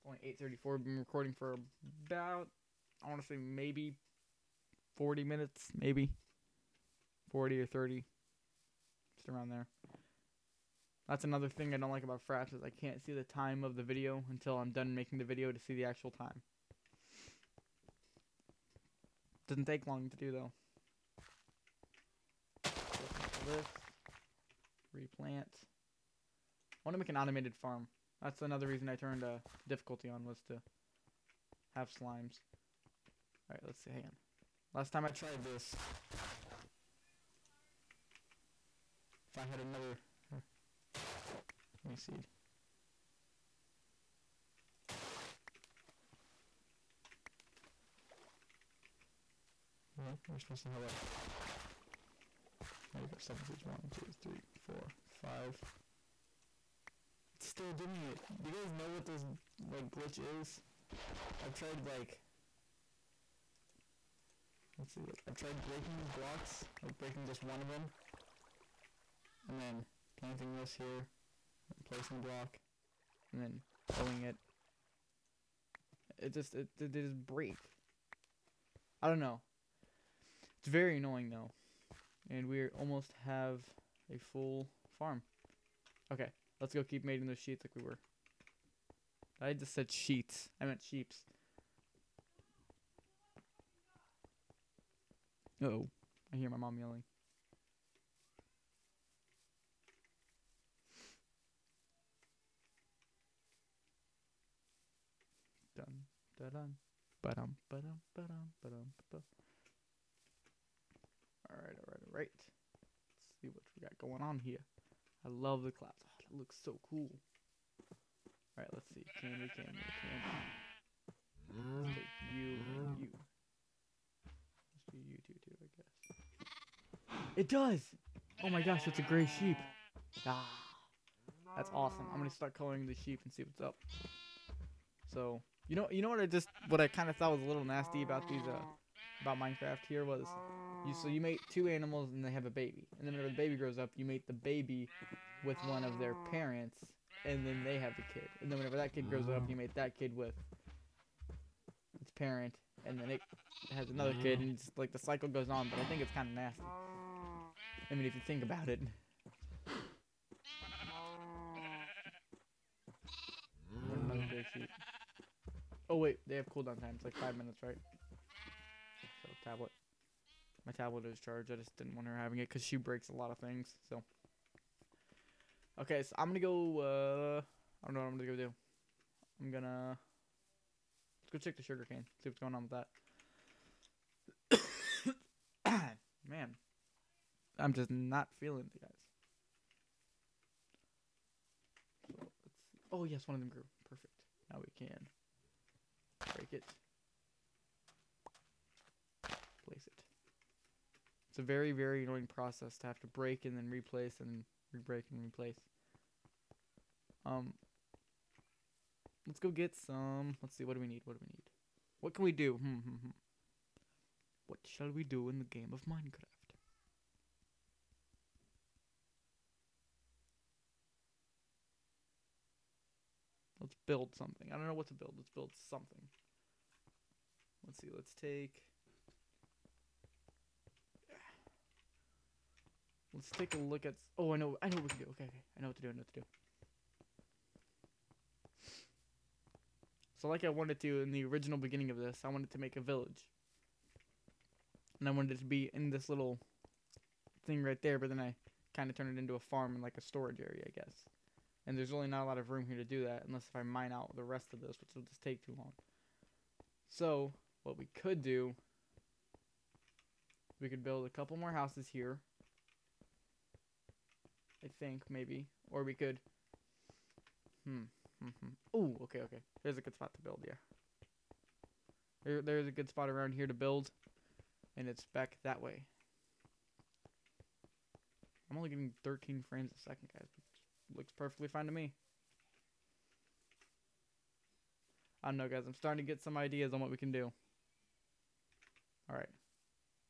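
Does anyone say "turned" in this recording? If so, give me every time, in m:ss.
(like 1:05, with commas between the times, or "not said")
0:28, 4:08.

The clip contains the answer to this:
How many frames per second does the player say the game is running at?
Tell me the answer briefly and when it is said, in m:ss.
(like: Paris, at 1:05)
13, at 4:39.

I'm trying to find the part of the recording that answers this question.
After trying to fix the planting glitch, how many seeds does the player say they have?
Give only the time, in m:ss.
0:53.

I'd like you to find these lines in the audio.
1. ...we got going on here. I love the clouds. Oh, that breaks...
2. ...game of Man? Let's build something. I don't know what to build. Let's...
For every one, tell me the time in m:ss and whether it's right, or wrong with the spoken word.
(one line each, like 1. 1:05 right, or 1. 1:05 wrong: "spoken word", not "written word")
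1. 1:53 wrong: "looks", not "breaks"
2. 3:35 wrong: "Minecraft", not "Man".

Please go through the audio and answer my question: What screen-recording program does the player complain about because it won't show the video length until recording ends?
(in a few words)
Fraps.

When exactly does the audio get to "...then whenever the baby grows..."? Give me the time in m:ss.
2:23.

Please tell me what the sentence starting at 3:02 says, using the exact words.
See what's going on with that.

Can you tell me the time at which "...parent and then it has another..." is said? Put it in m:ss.
2:32.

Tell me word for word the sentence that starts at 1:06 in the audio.
Like breaking just one of them.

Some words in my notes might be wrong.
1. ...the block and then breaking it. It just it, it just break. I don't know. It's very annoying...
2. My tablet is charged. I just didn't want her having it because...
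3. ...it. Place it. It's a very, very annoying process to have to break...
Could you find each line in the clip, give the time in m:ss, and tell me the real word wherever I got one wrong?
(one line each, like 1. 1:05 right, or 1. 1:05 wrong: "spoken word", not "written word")
1. 1:12 wrong: "pulling", not "breaking"
2. 2:50 right
3. 3:16 right.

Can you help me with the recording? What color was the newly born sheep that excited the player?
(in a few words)
gray.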